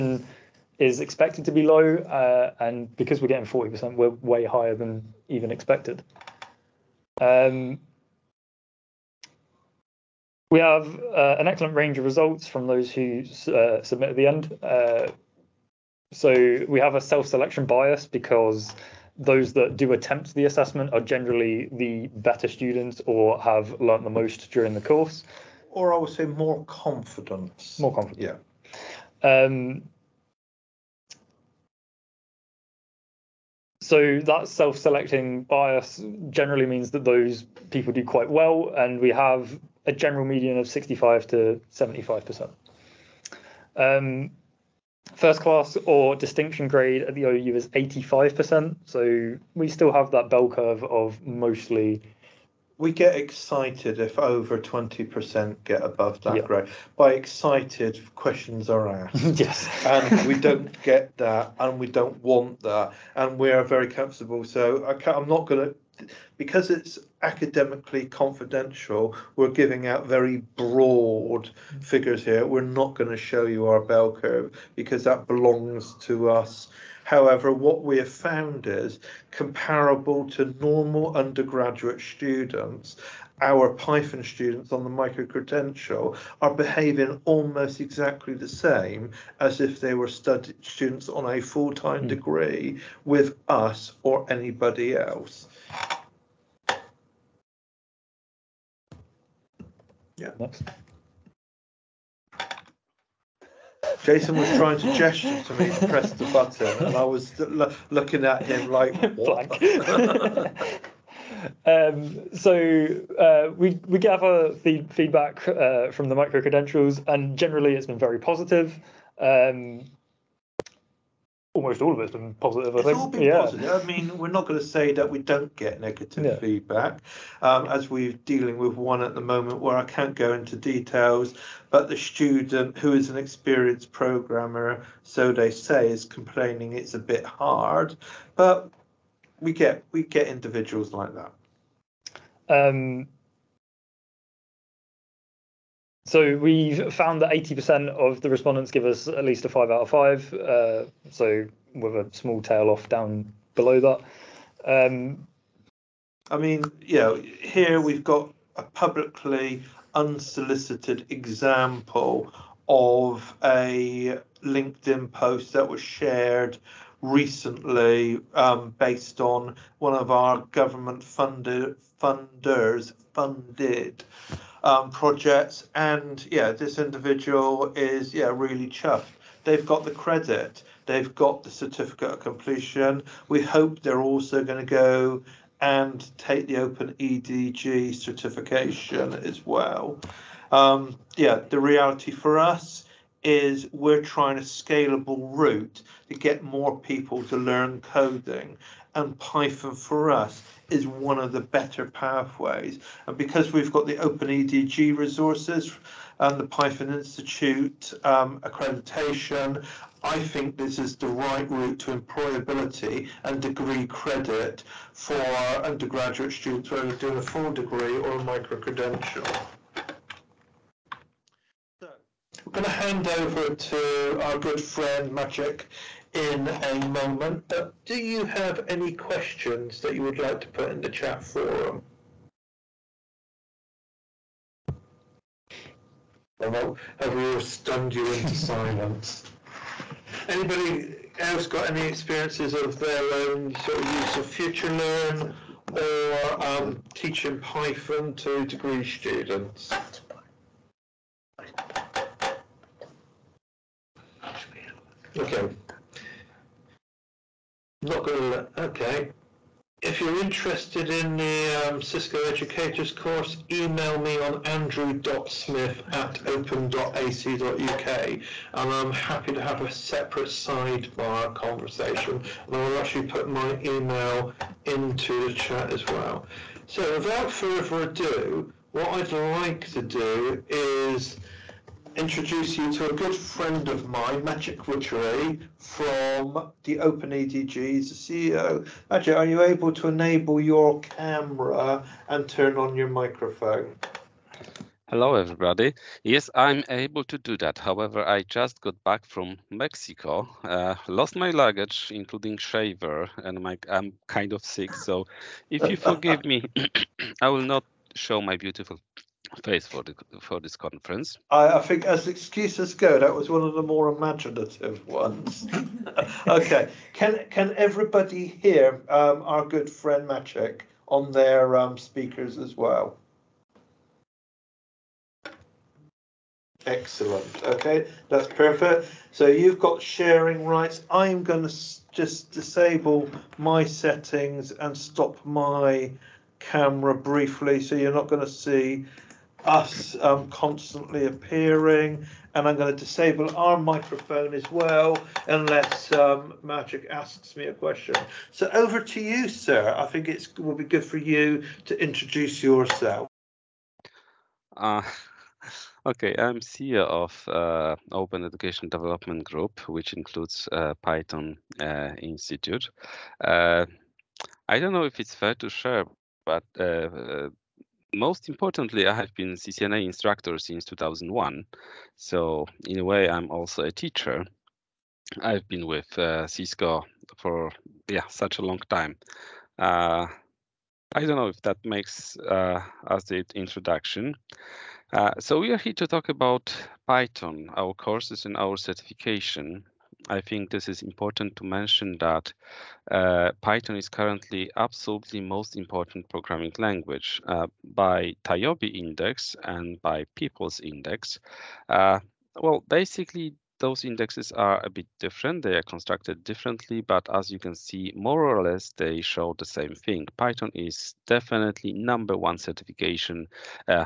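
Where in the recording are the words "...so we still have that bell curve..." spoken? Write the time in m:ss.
0:48.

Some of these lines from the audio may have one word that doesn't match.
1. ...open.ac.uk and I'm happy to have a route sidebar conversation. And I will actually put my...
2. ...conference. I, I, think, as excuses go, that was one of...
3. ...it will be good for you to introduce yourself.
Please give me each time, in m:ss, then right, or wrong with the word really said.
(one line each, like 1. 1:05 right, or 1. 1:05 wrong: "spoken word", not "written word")
1. 4:26 wrong: "separate", not "route"
2. 5:10 right
3. 5:50 right.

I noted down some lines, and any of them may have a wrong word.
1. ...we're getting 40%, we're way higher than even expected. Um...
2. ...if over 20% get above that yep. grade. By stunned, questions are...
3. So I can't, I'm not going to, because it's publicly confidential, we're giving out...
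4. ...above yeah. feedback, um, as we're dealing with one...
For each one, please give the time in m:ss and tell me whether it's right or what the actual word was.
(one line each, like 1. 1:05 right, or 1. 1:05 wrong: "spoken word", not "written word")
1. 0:03 right
2. 0:53 wrong: "excited", not "stunned"
3. 1:04 wrong: "academically", not "publicly"
4. 2:05 wrong: "negative", not "above".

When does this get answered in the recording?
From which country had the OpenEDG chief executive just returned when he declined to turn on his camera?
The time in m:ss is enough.
4:59.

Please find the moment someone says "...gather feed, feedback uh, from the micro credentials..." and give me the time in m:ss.
1:53.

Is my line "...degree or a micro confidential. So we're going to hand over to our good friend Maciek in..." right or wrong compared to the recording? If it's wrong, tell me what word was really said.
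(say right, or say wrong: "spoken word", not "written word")
wrong: "credential", not "confidential".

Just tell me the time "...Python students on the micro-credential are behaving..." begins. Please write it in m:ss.
1:23.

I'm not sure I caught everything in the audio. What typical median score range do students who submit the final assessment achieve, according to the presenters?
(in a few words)
65 to 75 percent.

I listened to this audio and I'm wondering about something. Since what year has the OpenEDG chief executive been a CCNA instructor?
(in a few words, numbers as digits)
2001.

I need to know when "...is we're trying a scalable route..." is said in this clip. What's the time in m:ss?
3:13.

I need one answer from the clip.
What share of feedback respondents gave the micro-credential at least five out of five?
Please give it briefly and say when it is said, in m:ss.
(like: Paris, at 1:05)
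80%, at 2:27.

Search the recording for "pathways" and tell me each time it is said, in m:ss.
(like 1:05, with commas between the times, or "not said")
3:21.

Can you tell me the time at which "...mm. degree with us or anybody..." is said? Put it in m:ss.
1:32.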